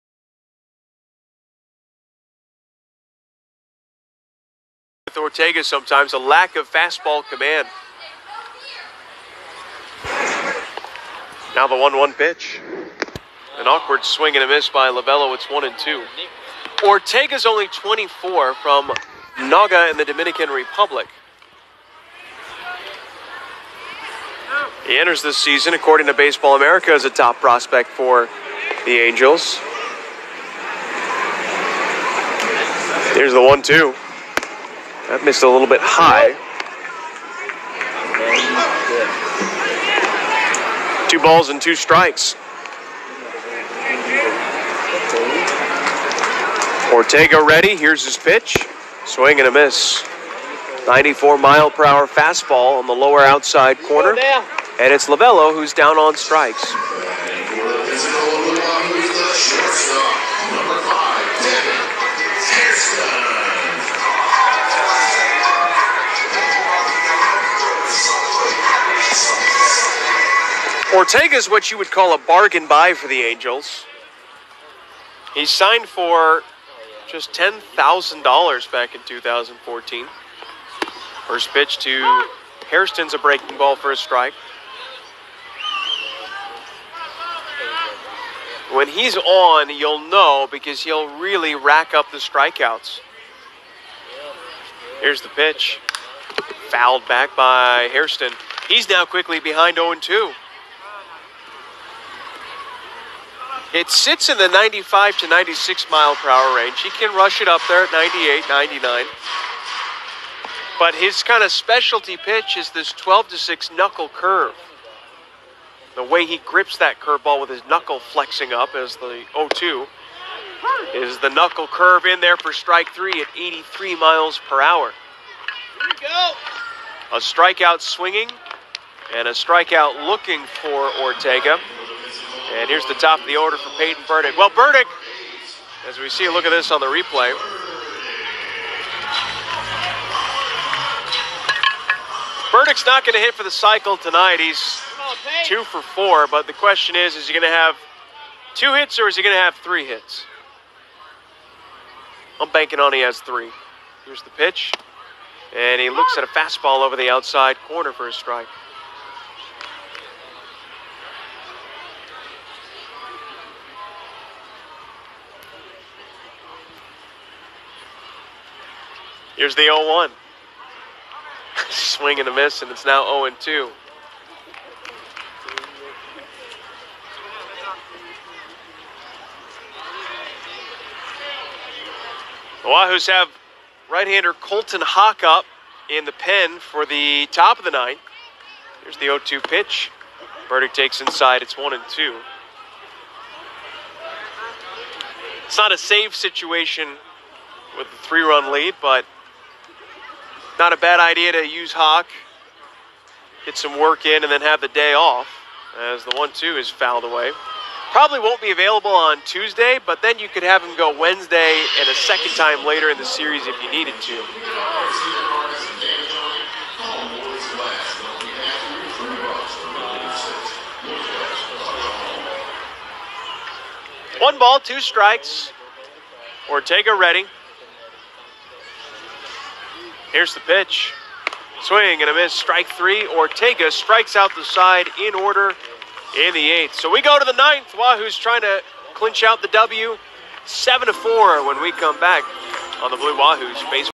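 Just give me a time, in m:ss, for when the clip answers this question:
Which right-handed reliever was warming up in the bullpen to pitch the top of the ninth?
3:04.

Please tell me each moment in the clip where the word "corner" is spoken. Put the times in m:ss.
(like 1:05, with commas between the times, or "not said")
0:53, 2:37.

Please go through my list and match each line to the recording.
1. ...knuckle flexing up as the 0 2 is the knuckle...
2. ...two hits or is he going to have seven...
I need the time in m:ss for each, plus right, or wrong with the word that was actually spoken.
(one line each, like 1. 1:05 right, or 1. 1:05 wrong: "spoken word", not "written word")
1. 1:57 right
2. 2:28 wrong: "three", not "seven".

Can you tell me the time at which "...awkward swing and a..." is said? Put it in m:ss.
0:13.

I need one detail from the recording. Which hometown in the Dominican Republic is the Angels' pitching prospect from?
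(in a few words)
Nagua.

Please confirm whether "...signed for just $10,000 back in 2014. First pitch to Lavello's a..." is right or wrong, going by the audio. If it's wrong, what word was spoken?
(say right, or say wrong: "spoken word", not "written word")
wrong: "Hairston", not "Lavello".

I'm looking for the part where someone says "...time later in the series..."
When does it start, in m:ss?
3:32.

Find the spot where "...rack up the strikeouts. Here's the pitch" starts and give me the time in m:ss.
1:31.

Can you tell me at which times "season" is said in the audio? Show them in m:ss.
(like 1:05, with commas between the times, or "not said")
0:25.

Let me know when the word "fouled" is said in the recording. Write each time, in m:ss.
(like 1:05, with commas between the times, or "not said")
1:36, 3:26.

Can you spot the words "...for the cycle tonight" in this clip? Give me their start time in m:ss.
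2:23.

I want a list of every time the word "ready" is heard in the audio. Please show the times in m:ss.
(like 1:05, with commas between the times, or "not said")
0:47, 3:46.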